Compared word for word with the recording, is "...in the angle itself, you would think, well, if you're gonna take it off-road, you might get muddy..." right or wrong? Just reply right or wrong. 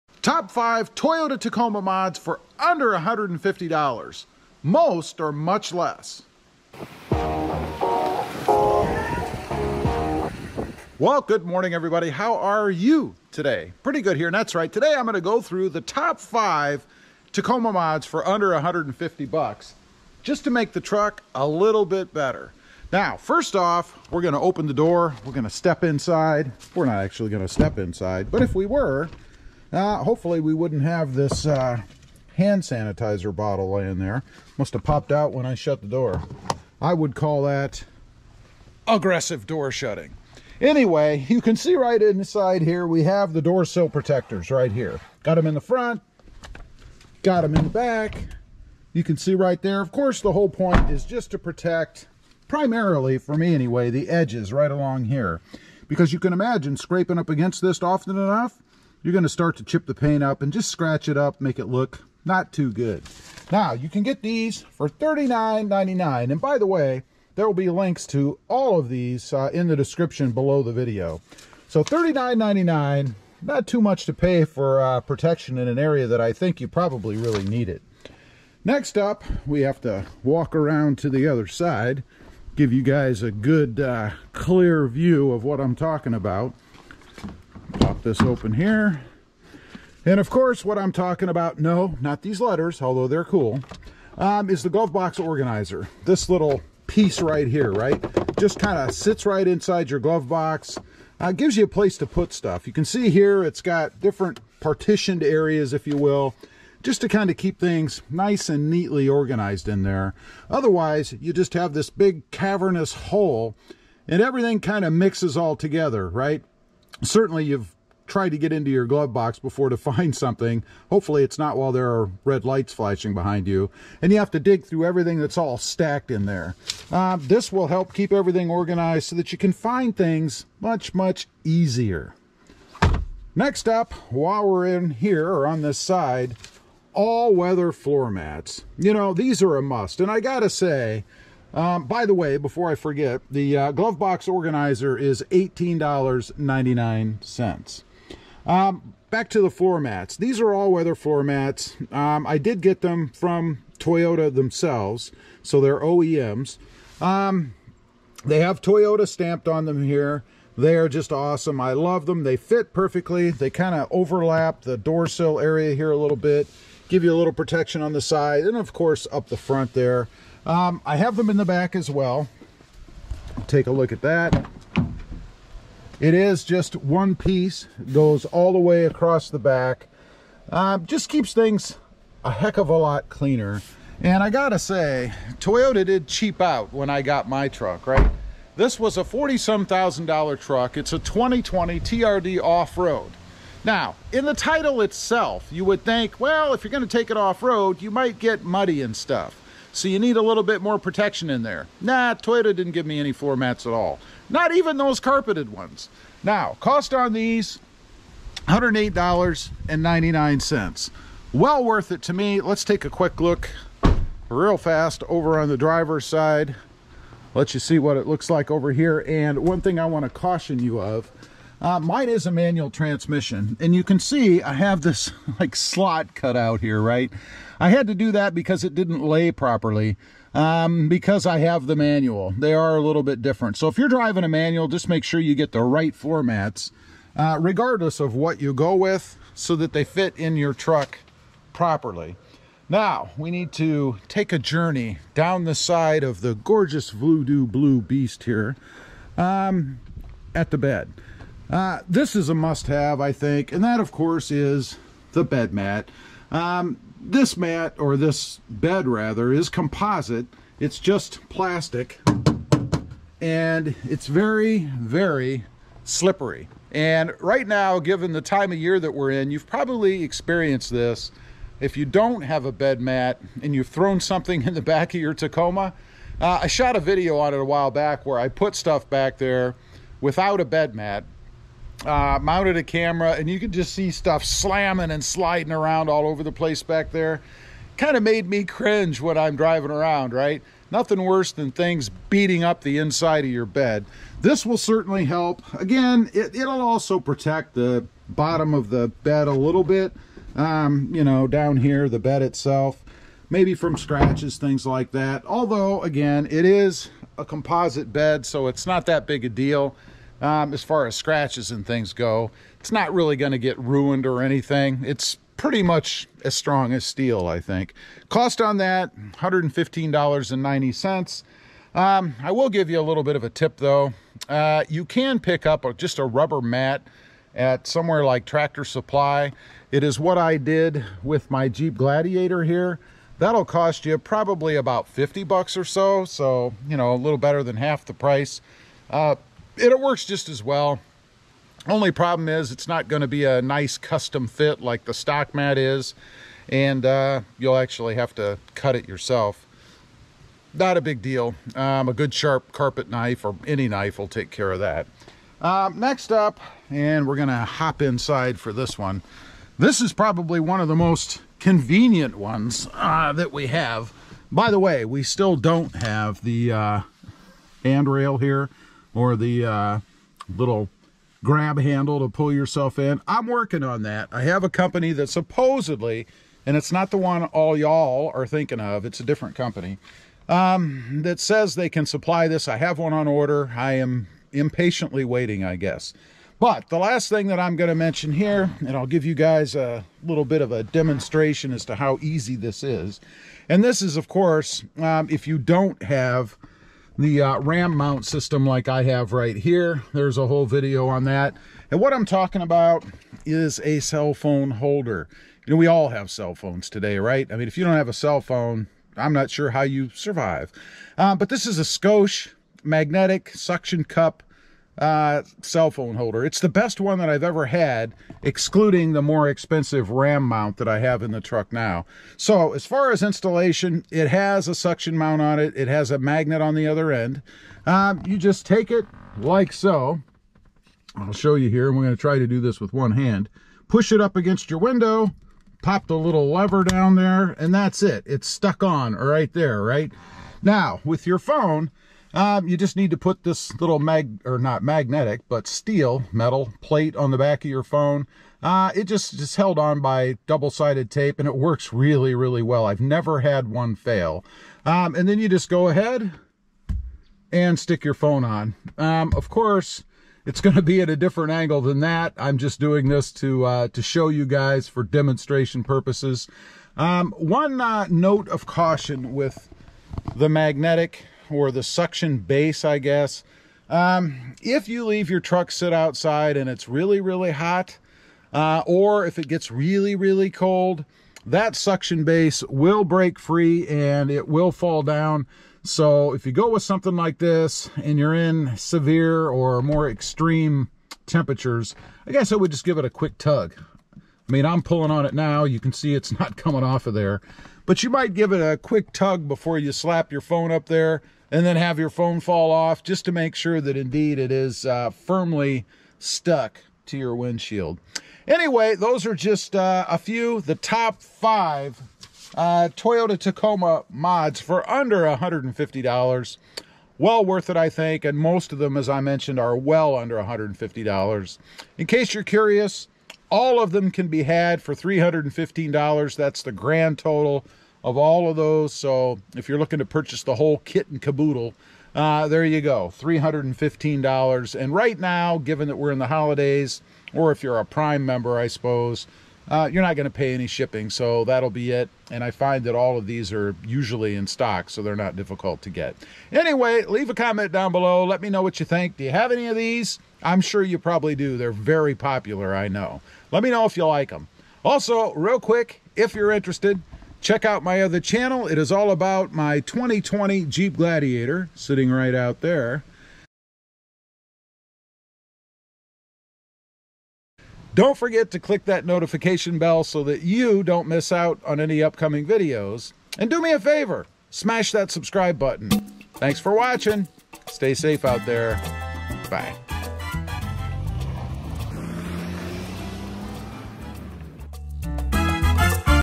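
wrong.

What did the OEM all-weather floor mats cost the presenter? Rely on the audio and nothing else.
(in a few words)
$108.99.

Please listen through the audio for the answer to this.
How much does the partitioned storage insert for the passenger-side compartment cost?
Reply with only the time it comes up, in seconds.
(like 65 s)
145 s.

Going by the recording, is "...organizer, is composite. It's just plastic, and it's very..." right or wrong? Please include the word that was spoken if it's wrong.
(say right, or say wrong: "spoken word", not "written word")
wrong: "rather", not "organizer".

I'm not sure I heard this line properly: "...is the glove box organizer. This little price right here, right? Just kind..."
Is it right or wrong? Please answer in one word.
wrong.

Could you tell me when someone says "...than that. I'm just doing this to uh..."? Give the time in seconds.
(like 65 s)
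461 s.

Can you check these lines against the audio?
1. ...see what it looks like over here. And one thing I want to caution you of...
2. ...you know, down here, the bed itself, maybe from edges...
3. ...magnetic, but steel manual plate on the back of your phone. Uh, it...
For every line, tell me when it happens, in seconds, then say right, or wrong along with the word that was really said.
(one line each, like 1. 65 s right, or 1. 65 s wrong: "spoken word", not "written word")
1. 217 s right
2. 300 s wrong: "scratches", not "edges"
3. 444 s wrong: "metal", not "manual".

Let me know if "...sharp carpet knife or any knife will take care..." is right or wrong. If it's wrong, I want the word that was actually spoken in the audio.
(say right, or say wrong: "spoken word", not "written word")
right.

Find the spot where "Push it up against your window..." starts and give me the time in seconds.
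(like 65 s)
433 s.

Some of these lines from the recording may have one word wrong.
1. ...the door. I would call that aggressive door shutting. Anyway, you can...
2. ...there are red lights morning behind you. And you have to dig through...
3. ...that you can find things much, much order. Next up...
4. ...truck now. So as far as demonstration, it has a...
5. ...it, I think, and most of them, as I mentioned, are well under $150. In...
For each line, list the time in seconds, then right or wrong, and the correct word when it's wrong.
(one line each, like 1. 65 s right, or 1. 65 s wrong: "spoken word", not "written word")
1. 35 s right
2. 121 s wrong: "flashing", not "morning"
3. 129 s wrong: "easier", not "order"
4. 421 s wrong: "installation", not "demonstration"
5. 517 s right.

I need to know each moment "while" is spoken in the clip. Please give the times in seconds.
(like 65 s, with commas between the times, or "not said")
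121 s, 134 s, 277 s.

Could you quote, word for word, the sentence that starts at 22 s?
Now, first off, we're going to open the door.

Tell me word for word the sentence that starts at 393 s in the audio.
And this is, of course, um, if you don't have the uh, ram mount system like I have right here.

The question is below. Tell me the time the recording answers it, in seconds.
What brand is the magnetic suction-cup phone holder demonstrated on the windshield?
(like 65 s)
411 s.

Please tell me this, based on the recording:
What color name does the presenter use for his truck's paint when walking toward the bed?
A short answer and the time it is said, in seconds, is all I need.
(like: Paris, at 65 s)
voodoo blue, at 246 s.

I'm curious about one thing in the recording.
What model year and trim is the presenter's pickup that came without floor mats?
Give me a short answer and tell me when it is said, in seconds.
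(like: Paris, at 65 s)
2020 TRD off-road, at 190 s.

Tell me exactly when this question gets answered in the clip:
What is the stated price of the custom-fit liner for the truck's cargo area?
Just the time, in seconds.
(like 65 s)
318 s.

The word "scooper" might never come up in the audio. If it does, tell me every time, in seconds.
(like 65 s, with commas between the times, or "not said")
not said.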